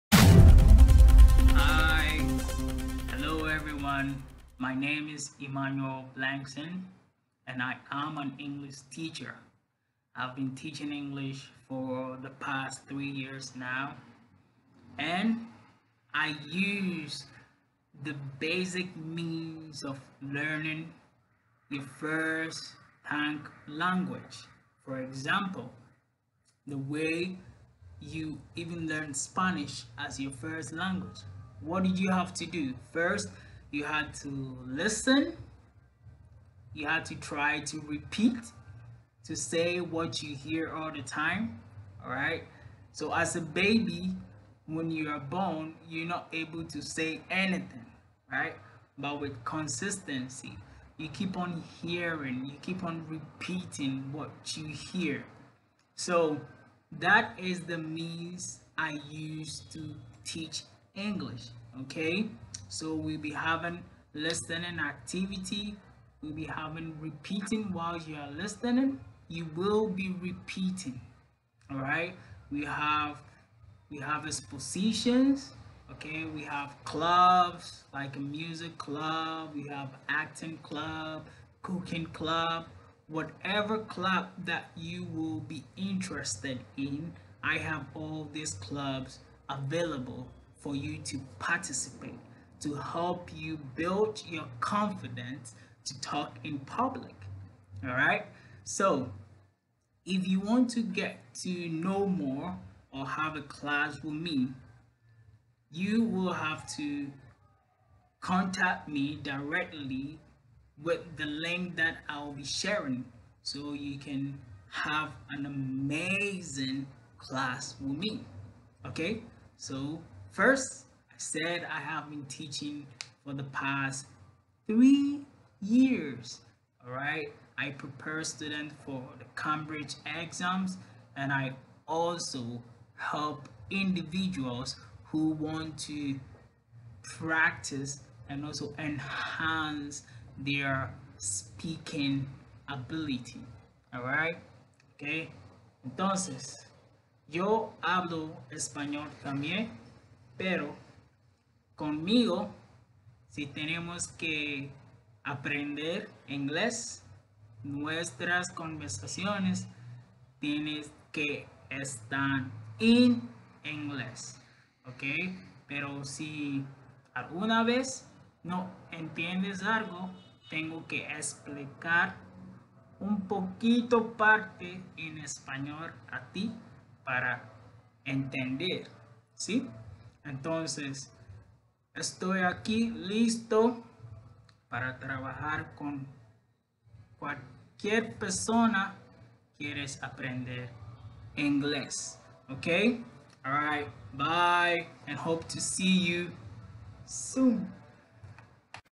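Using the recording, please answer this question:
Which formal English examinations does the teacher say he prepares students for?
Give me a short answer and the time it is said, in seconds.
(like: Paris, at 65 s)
Cambridge exams, at 129 s.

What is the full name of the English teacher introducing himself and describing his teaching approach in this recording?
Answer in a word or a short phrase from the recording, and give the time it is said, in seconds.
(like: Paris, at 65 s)
Emmanuel Blankson, at 5 s.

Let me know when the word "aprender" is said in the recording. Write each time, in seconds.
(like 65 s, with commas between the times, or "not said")
155 s, 190 s.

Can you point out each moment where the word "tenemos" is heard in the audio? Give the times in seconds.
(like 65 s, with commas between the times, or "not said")
153 s.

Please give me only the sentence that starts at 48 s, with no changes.
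But with consistency, you keep on hearing, you keep on repeating what you hear.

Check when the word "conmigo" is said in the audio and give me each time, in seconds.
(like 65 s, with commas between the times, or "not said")
151 s.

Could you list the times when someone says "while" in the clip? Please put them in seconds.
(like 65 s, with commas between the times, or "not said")
67 s.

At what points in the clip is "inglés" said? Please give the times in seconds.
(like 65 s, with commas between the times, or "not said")
156 s, 163 s, 191 s.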